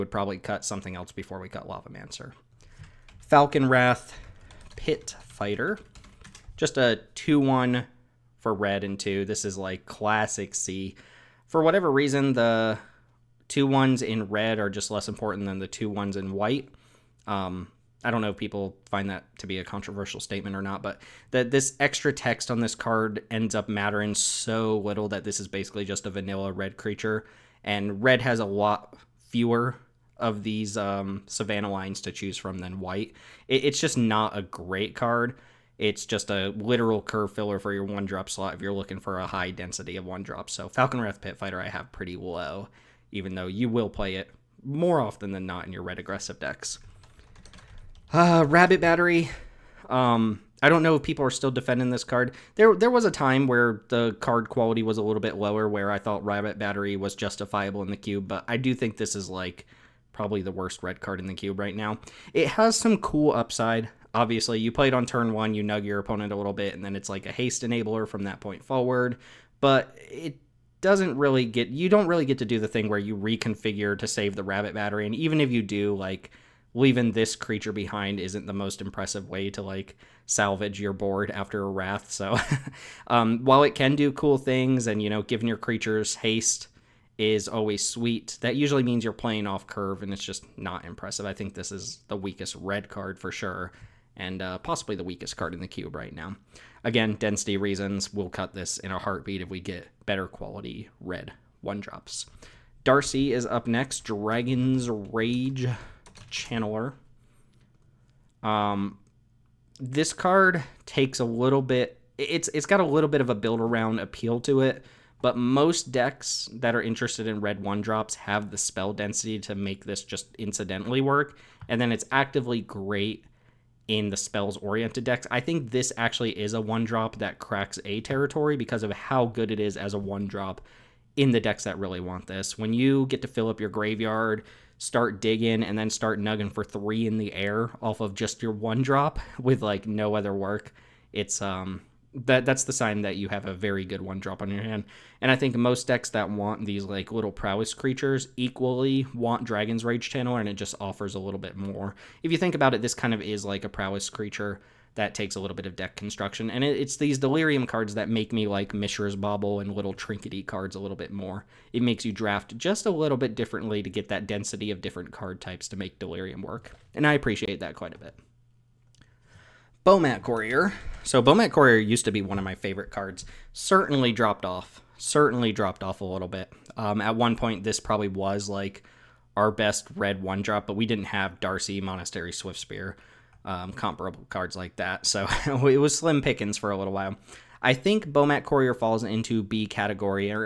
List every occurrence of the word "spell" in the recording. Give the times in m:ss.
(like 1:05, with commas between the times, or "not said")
1:58, 2:04.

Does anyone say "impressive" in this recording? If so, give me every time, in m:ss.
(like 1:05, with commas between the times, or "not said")
1:18, 1:30.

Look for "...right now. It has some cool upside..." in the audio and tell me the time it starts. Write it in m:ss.
1:01.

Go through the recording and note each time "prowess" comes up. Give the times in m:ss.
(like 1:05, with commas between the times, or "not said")
2:27, 2:33.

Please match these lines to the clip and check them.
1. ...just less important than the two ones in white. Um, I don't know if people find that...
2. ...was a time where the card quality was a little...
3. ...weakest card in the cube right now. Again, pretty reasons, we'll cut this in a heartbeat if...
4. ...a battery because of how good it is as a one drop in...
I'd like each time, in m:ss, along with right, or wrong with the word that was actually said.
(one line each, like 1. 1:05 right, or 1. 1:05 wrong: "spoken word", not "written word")
1. 0:14 right
2. 0:52 right
3. 1:35 wrong: "density", not "pretty"
4. 2:07 wrong: "territory", not "battery".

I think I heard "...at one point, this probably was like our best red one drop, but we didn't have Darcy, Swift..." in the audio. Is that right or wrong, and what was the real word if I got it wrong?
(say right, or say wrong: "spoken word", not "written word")
wrong: "Monastery", not "Swift".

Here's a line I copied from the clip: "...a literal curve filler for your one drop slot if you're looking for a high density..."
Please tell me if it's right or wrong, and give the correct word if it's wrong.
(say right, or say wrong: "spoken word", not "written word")
right.